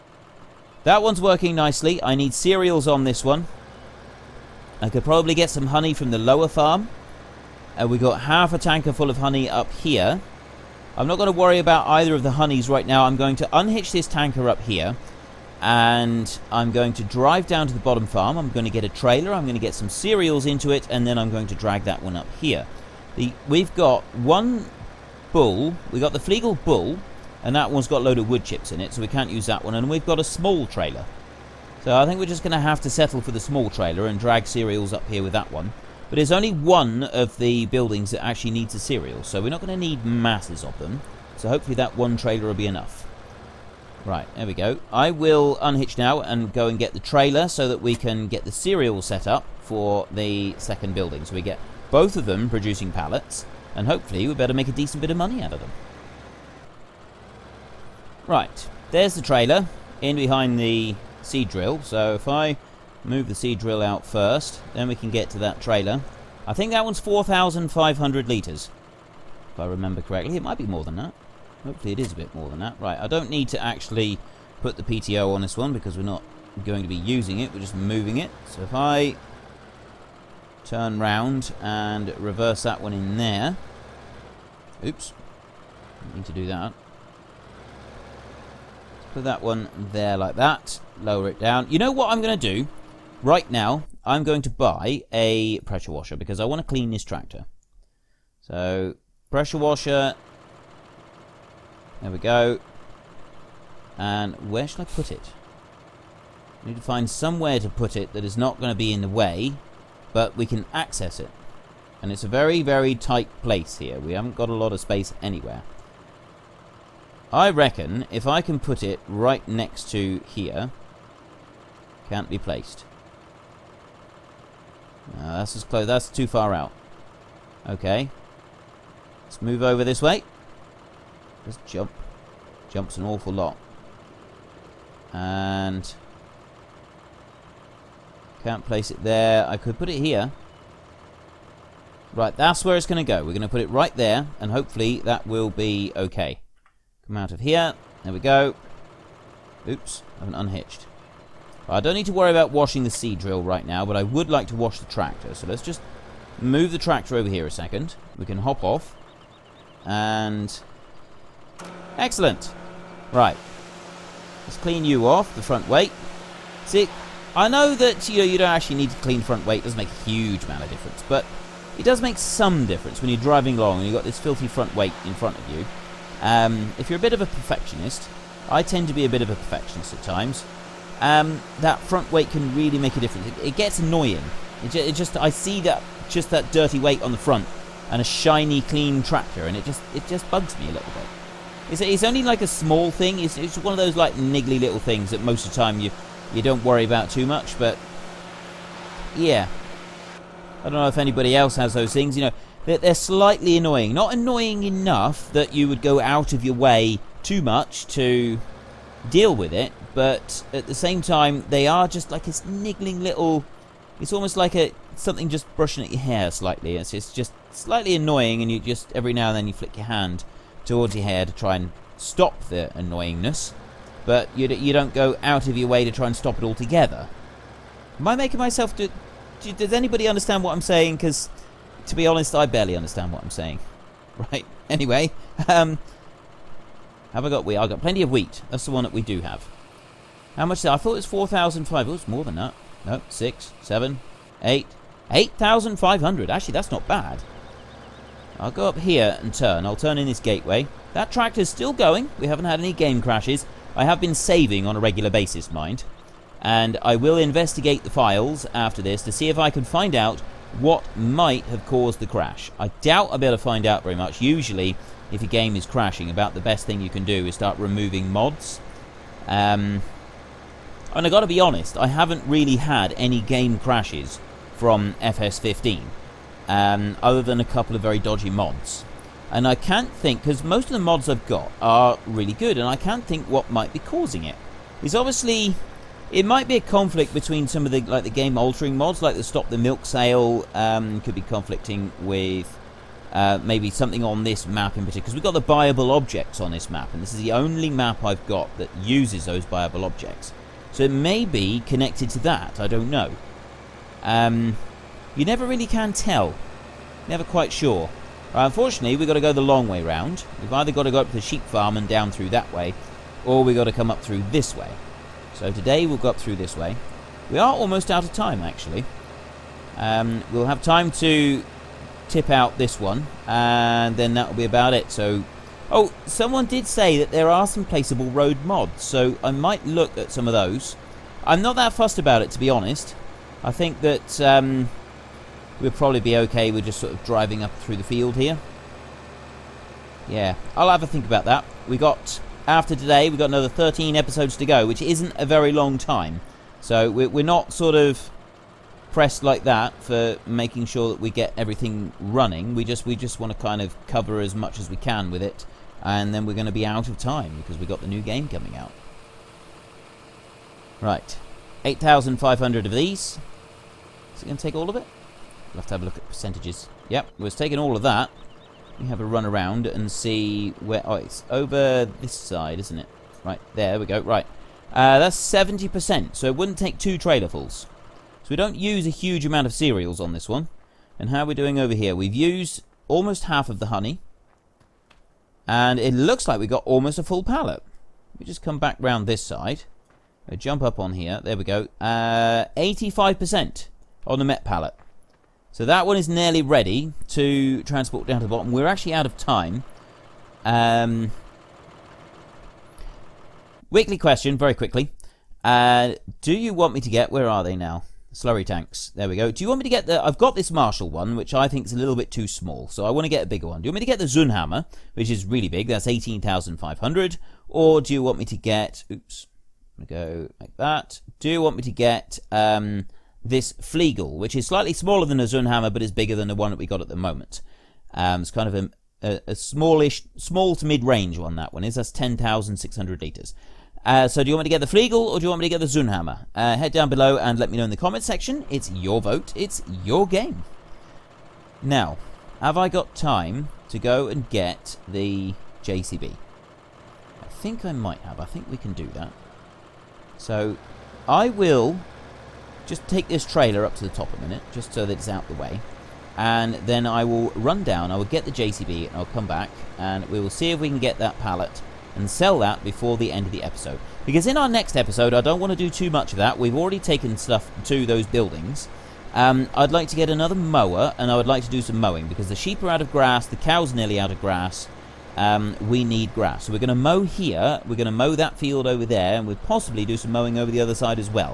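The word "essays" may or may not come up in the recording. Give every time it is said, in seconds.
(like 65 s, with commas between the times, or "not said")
not said.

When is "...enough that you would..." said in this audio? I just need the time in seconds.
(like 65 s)
204 s.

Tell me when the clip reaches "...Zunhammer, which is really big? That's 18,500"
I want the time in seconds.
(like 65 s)
414 s.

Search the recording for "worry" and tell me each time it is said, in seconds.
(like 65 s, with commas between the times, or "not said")
11 s, 152 s, 196 s.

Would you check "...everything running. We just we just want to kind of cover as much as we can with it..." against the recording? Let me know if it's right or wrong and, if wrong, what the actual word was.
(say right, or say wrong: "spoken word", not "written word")
right.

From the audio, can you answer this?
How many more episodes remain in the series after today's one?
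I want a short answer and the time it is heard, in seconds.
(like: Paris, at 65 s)
13, at 343 s.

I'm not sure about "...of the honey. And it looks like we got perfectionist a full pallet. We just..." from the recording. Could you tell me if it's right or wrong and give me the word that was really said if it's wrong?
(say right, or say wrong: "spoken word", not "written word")
wrong: "almost", not "perfectionist".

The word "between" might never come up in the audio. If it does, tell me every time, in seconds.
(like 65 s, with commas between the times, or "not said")
287 s.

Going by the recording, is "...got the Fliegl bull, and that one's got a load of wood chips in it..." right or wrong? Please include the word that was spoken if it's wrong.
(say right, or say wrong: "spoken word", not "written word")
right.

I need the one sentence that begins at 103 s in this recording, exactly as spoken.
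And where shall I put it?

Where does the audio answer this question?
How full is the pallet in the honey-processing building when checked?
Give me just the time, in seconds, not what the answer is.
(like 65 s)
391 s.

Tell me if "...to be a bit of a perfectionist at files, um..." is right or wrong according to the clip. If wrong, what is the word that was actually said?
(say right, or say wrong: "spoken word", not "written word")
wrong: "times", not "files".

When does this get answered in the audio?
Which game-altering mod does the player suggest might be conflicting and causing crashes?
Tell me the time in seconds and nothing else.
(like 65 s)
289 s.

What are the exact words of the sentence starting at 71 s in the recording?
Hopefully it is a bit more than that.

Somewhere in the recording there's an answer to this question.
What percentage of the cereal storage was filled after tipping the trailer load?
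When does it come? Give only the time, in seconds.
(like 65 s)
375 s.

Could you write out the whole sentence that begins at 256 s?
And I will investigate the files after this to see if I can find out what might have caused the crash.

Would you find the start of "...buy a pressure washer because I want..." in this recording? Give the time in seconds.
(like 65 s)
94 s.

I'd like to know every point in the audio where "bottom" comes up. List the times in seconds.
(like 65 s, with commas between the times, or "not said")
17 s, 398 s.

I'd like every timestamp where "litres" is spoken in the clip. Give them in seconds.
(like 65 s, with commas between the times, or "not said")
68 s, 433 s.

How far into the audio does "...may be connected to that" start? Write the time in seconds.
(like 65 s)
300 s.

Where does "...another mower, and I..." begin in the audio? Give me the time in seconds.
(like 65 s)
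470 s.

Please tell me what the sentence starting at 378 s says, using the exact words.
So we don't use a huge amount of cereals on this one.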